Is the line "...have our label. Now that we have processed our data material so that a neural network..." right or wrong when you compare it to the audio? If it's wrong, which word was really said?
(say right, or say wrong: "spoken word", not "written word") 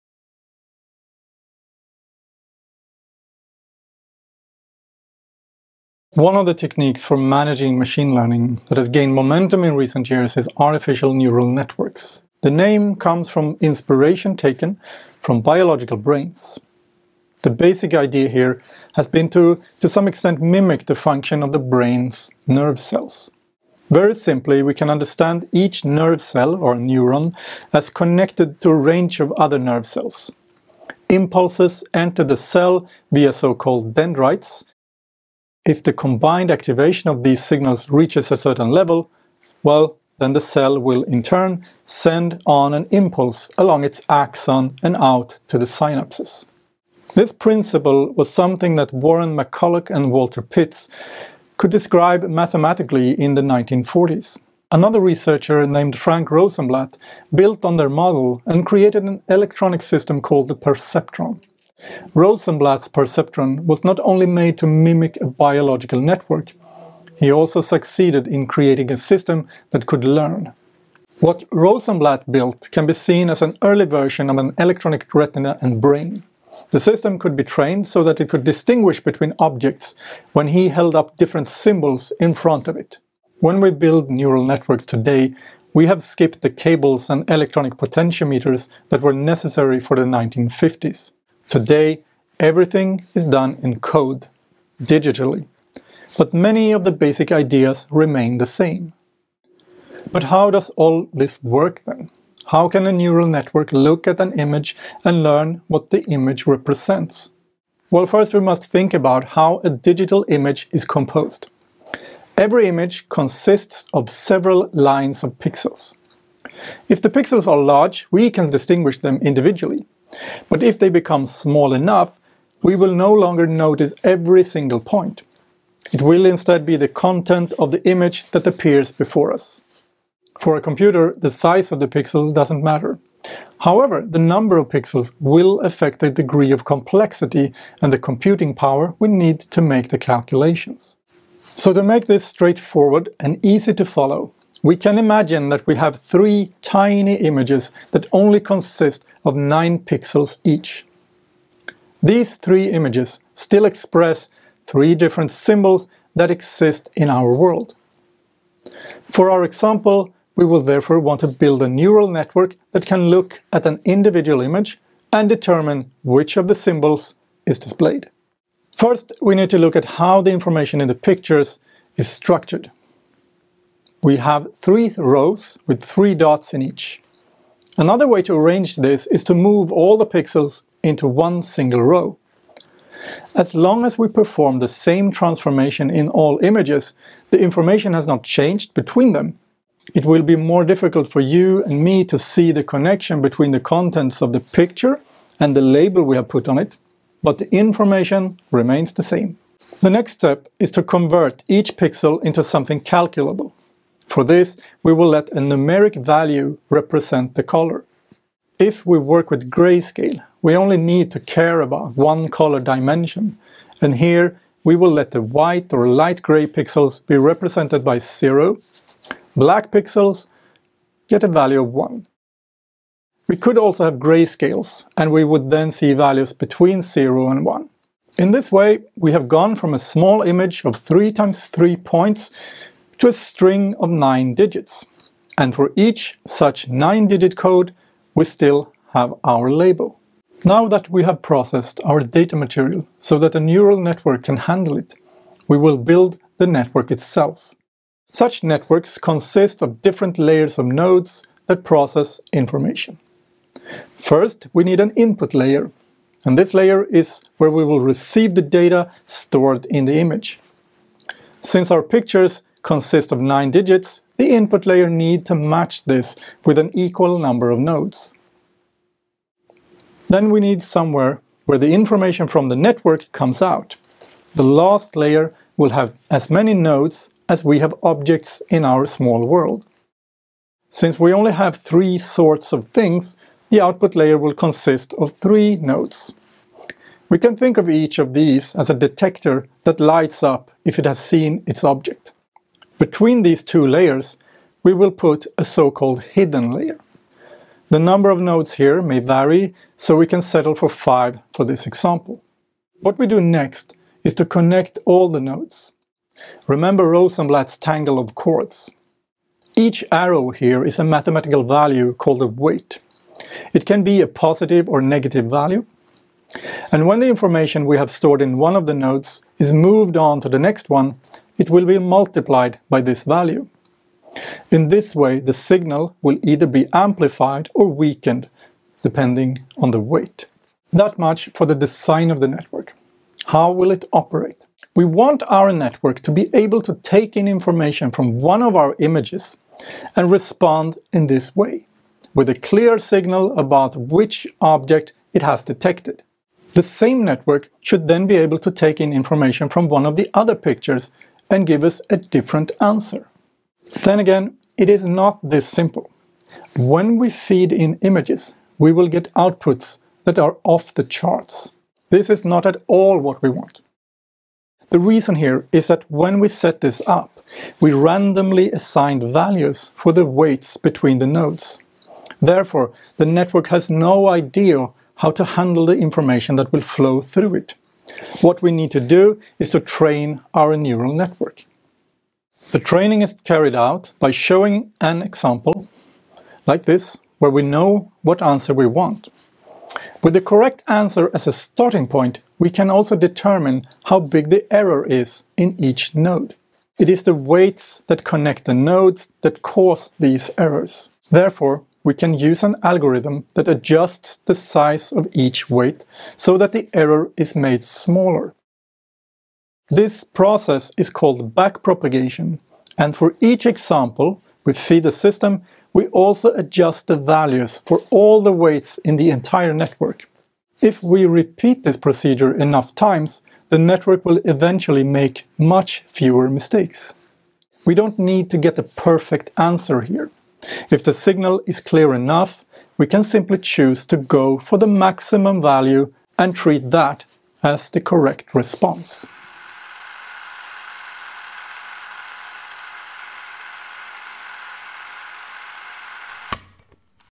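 right.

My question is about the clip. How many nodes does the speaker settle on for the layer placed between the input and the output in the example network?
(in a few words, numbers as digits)
5.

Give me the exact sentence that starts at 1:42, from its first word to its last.
How can a neural network look at an image and learn what the image represents?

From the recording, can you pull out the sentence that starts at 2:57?
Another way to arrange this is to move all the pixels into one single row.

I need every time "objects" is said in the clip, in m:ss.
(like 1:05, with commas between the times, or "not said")
1:19, 4:37, 4:51, 5:44.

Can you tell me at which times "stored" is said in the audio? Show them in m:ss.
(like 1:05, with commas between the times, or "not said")
4:19, 5:17.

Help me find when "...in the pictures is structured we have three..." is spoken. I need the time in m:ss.
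2:50.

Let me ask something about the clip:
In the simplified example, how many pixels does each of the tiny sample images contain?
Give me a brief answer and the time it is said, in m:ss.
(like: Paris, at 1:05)
9, at 2:29.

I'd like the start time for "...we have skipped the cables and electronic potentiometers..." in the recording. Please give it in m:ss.
1:25.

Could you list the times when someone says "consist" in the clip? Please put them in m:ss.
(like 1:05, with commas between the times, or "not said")
1:53, 2:28, 4:08, 4:22, 4:44.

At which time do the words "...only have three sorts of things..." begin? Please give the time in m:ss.
4:41.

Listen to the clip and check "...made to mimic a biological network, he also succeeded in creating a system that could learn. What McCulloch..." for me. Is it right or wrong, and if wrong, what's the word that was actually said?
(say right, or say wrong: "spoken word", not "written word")
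wrong: "Rosenblatt", not "McCulloch".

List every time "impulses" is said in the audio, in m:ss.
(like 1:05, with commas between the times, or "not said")
0:31, 0:42.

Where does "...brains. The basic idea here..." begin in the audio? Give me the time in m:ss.
0:15.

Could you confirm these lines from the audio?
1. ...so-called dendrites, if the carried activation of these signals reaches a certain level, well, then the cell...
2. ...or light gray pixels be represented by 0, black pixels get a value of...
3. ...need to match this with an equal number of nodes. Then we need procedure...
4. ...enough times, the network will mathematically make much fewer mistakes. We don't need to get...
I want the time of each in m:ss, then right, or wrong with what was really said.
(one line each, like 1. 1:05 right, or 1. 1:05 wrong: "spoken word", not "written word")
1. 0:33 wrong: "combined", not "carried"
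2. 3:35 right
3. 4:24 wrong: "somewhere", not "procedure"
4. 7:02 wrong: "eventually", not "mathematically".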